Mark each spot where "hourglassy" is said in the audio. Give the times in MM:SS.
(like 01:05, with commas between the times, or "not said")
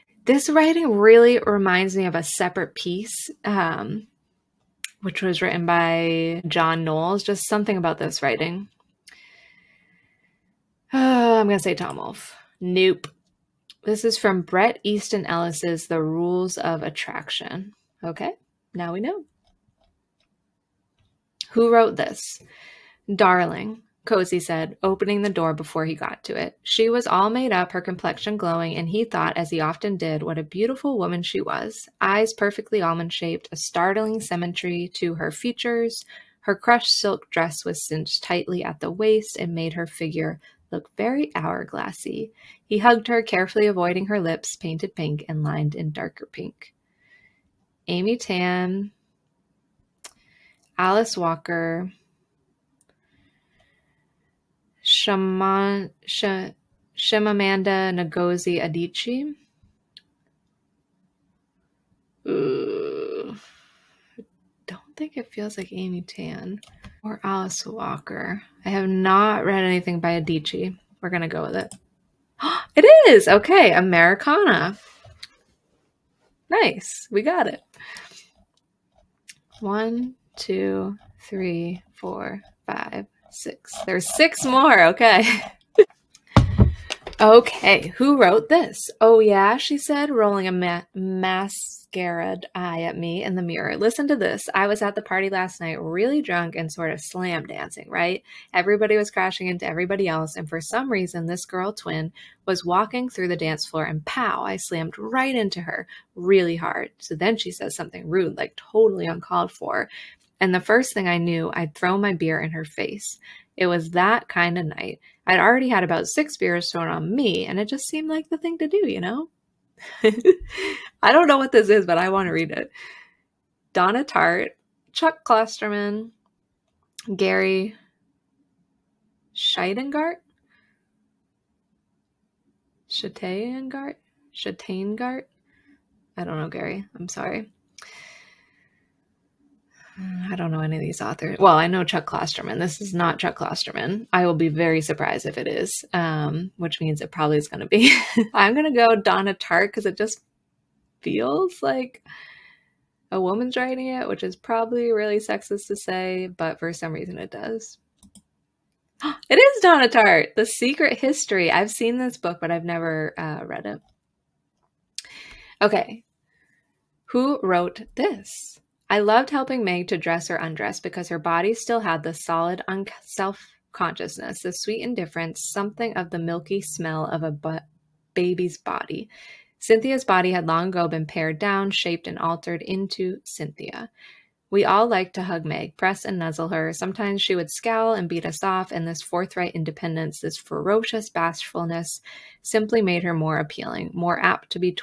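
00:41.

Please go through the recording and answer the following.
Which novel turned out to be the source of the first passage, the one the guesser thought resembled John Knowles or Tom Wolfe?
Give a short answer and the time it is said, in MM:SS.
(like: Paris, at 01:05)
The Rules of Attraction, at 00:15.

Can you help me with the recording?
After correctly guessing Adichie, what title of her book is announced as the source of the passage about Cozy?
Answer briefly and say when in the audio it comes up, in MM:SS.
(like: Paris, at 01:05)
Americanah, at 01:13.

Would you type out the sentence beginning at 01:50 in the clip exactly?
And the first thing I knew, I'd throw my beer in her face.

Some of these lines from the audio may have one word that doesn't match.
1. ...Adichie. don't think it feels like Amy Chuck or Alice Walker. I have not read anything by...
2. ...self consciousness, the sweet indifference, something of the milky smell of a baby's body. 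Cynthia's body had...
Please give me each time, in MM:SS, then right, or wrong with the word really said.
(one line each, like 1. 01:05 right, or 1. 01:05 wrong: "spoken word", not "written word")
1. 00:58 wrong: "Tan", not "Chuck"
2. 02:53 right.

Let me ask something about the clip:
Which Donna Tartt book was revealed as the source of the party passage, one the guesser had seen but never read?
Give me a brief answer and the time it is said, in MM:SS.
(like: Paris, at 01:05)
The Secret History, at 02:40.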